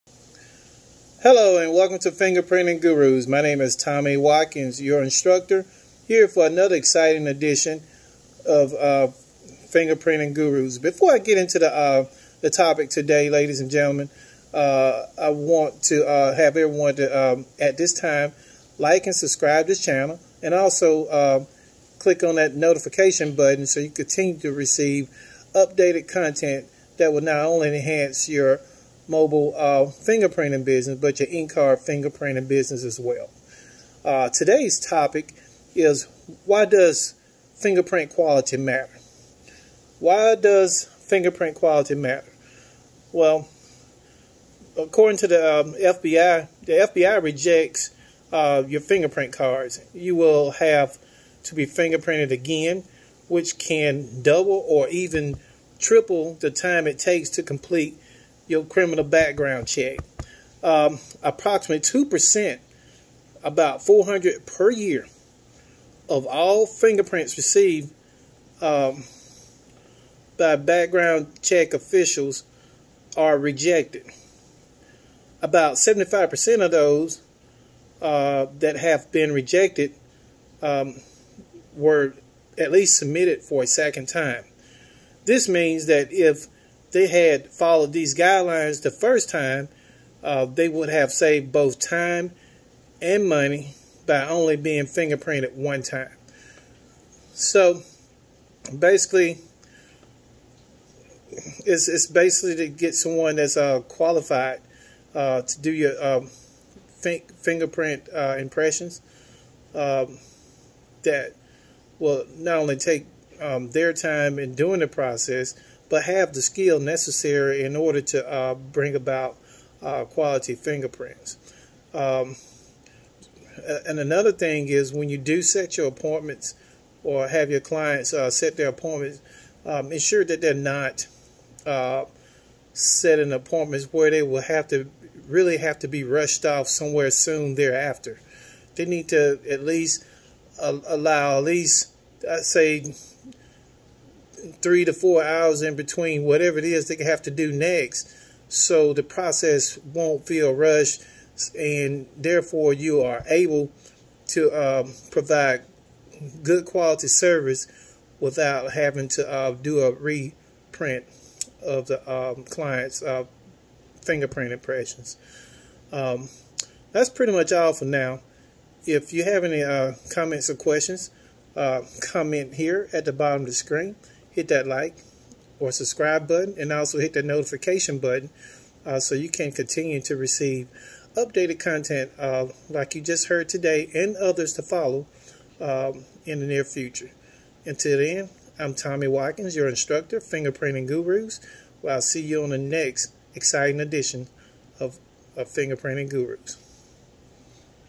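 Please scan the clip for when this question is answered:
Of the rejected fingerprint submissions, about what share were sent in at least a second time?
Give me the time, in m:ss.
1:15.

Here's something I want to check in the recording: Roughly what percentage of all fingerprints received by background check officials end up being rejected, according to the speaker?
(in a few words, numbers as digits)
2%.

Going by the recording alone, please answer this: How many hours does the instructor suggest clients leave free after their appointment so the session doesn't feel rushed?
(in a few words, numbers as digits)
3 to 4 hours.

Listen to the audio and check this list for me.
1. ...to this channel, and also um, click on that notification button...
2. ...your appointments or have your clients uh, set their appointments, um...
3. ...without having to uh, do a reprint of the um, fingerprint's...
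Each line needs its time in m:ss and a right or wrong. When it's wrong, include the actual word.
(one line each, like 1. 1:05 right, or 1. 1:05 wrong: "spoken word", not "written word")
1. 0:19 right
2. 2:05 right
3. 2:38 wrong: "client", not "fingerprint".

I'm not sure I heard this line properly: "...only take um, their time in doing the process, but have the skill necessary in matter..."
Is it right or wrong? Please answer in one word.
wrong.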